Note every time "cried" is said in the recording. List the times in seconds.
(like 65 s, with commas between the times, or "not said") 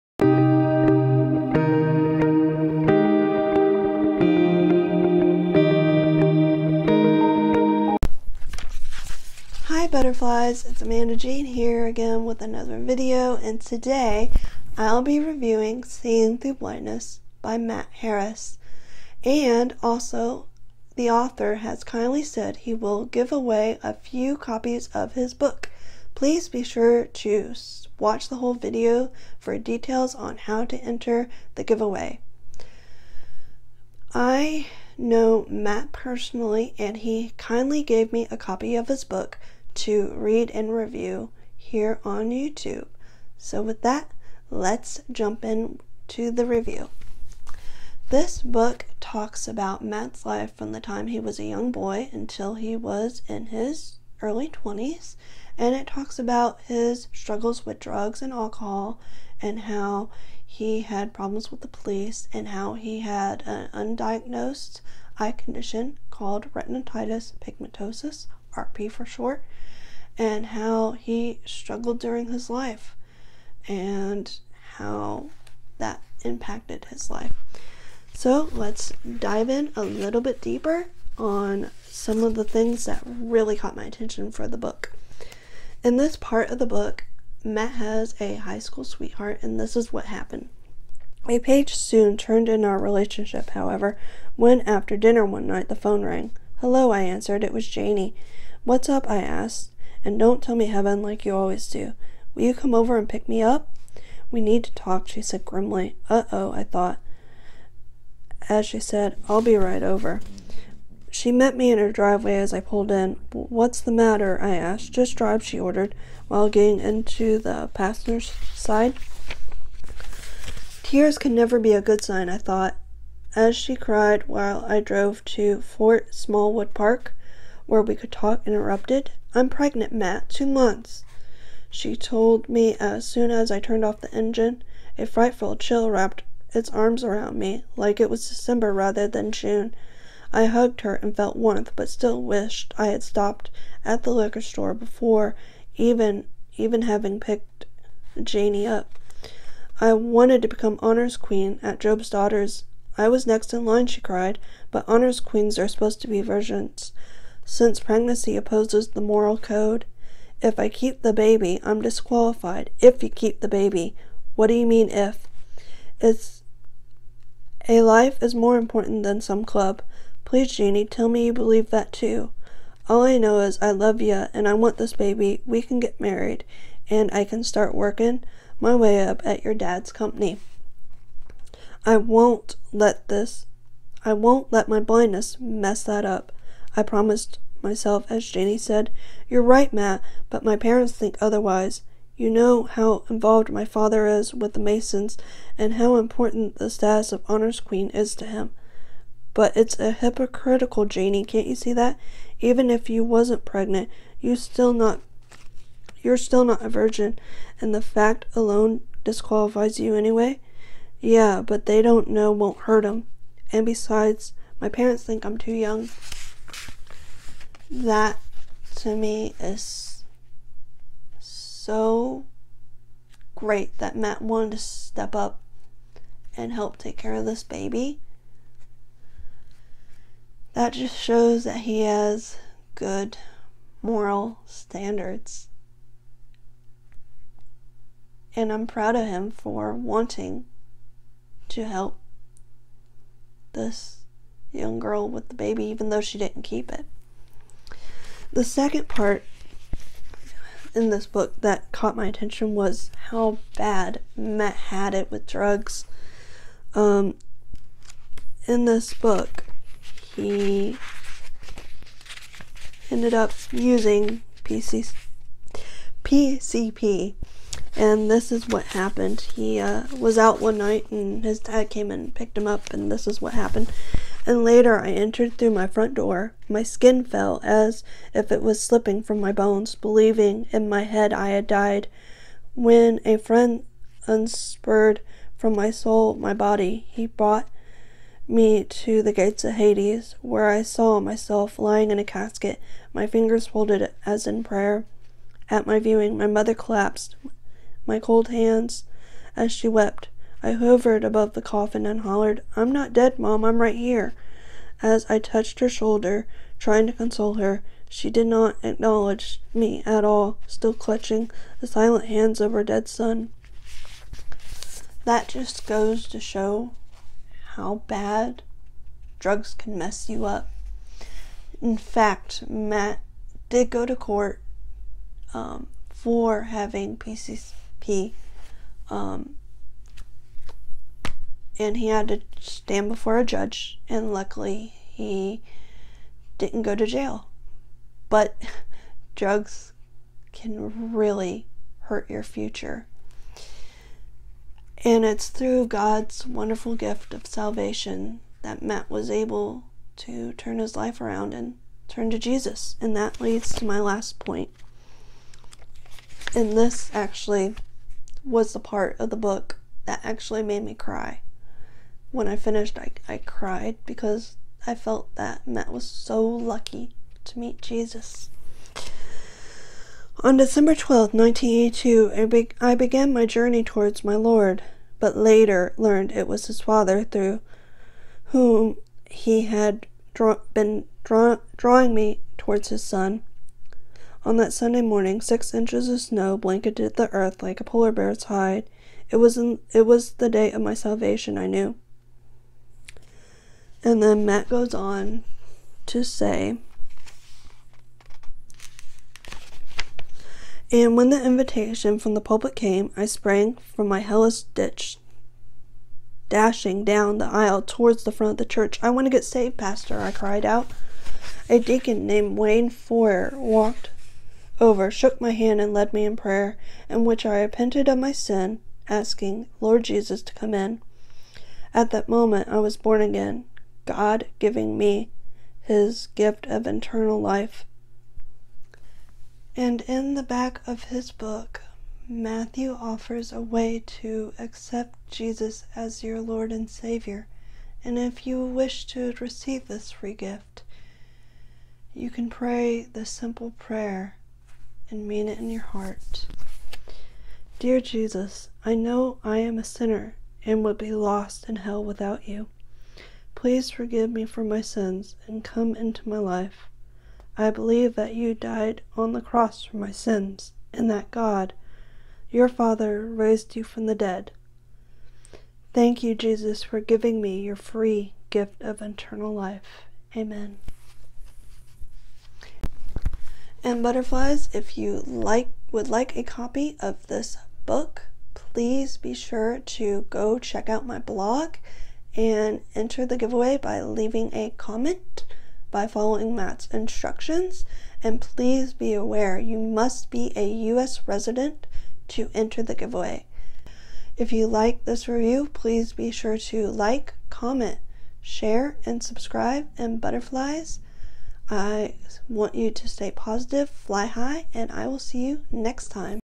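123 s, 154 s, 363 s, 410 s.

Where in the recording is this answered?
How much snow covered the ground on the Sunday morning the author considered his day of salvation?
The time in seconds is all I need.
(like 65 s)
385 s.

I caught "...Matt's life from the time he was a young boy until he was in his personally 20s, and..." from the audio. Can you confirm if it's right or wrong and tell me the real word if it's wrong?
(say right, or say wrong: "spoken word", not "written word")
wrong: "early", not "personally".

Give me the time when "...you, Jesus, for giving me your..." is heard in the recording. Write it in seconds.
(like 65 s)
466 s.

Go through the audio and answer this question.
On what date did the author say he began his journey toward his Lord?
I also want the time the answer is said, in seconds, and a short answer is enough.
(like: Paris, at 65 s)
December 12, 1982, at 370 s.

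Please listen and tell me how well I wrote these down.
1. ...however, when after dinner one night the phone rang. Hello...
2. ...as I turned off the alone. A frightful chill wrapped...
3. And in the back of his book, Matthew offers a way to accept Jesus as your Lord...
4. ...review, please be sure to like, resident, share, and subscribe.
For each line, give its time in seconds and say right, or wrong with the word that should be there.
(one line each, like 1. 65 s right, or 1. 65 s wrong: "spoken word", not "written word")
1. 93 s right
2. 133 s wrong: "engine", not "alone"
3. 429 s right
4. 495 s wrong: "comment", not "resident".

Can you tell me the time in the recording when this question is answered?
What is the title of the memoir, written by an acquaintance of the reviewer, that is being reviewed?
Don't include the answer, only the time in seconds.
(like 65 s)
15 s.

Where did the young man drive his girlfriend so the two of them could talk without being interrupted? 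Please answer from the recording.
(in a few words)
Fort Smallwood Park.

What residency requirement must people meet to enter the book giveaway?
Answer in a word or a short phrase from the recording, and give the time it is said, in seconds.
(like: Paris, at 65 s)
US resident, at 490 s.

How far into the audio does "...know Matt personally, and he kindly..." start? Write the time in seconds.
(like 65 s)
34 s.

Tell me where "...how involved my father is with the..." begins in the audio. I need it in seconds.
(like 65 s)
192 s.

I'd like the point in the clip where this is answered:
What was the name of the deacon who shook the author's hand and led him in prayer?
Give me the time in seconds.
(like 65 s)
412 s.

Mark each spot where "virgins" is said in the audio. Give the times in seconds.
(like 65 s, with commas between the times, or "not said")
156 s, 206 s.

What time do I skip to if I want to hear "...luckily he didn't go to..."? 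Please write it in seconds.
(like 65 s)
334 s.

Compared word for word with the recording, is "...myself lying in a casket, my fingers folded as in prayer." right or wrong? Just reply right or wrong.
right.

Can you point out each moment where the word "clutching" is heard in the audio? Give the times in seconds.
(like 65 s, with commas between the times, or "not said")
310 s.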